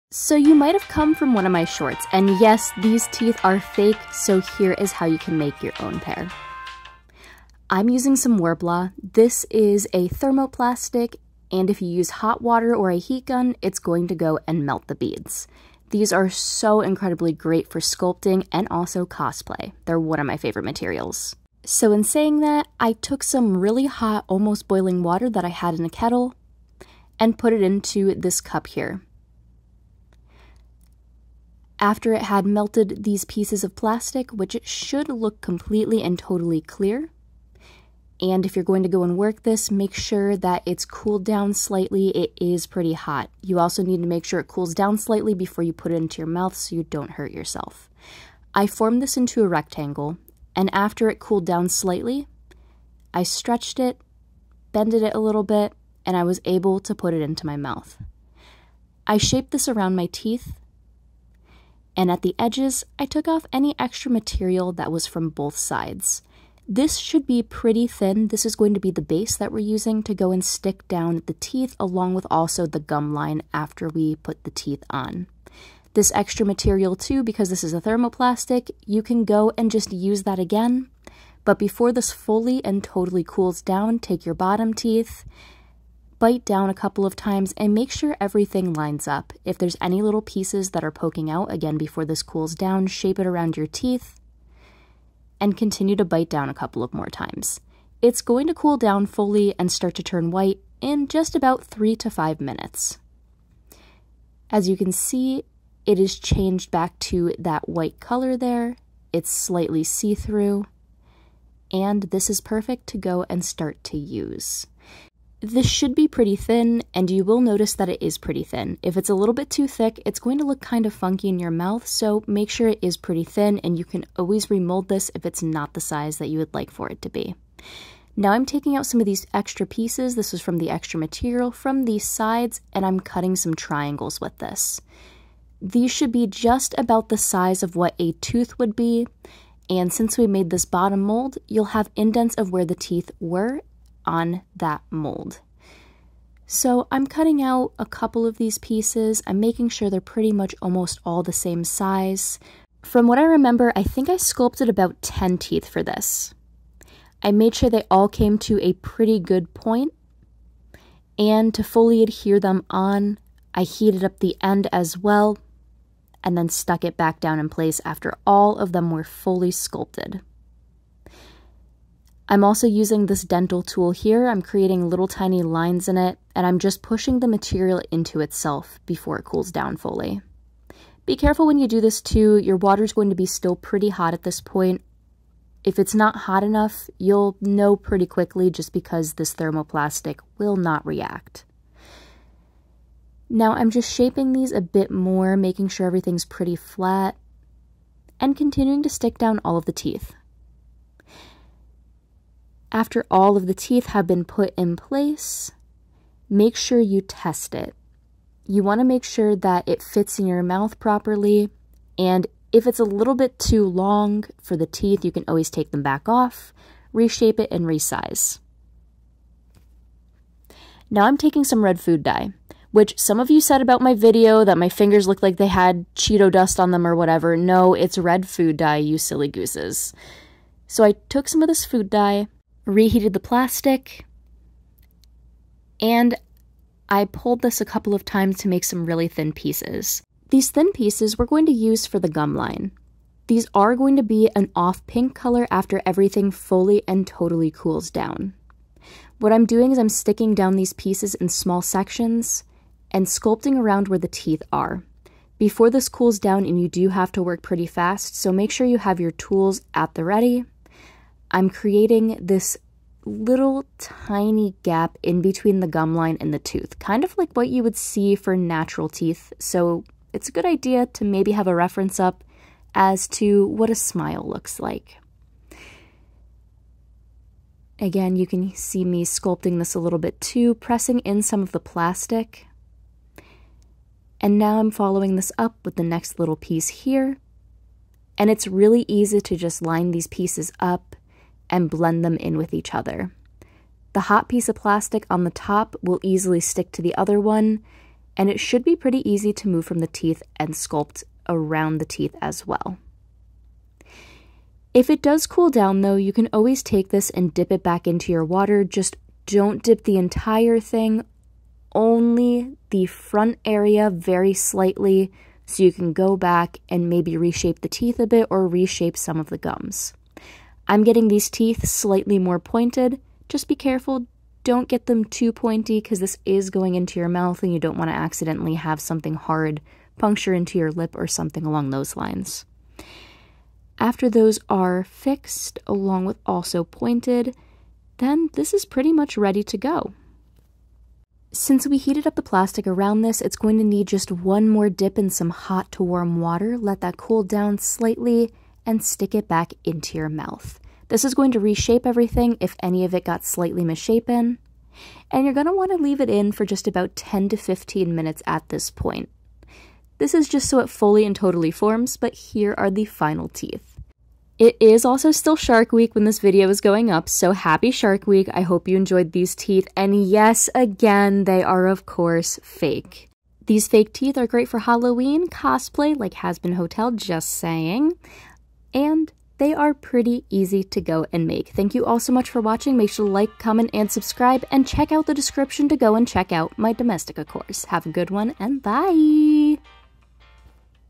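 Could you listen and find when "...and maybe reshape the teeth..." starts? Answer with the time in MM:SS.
05:16.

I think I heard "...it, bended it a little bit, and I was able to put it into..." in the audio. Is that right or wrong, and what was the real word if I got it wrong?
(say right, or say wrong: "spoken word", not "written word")
right.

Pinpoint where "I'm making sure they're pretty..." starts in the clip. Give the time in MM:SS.
02:29.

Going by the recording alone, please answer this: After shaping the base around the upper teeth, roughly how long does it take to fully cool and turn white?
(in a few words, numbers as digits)
3 to 5 minutes.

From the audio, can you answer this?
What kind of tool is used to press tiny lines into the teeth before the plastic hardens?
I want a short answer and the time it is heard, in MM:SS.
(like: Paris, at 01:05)
Dental tool, at 02:53.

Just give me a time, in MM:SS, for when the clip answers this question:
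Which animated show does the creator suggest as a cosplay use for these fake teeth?
06:16.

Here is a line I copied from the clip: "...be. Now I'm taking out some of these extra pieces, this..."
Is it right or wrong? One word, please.
right.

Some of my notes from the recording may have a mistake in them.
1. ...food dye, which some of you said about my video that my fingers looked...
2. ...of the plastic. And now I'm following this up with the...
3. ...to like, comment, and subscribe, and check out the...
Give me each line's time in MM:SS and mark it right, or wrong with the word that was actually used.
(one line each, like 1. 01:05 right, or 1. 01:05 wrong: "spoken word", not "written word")
1. 03:41 right
2. 04:41 right
3. 06:23 right.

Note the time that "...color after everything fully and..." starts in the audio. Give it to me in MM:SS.
04:05.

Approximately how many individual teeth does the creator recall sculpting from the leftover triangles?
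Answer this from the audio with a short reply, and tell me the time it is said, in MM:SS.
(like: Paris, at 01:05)
10, at 02:35.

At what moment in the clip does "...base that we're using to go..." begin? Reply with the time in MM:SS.
01:09.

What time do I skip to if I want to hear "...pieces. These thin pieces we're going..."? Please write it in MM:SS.
03:59.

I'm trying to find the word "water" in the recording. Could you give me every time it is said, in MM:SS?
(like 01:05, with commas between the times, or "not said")
00:12, 00:25, 03:02, 05:08, 05:46.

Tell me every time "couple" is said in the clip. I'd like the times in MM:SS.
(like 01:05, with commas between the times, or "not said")
01:26, 01:36, 02:27, 03:57.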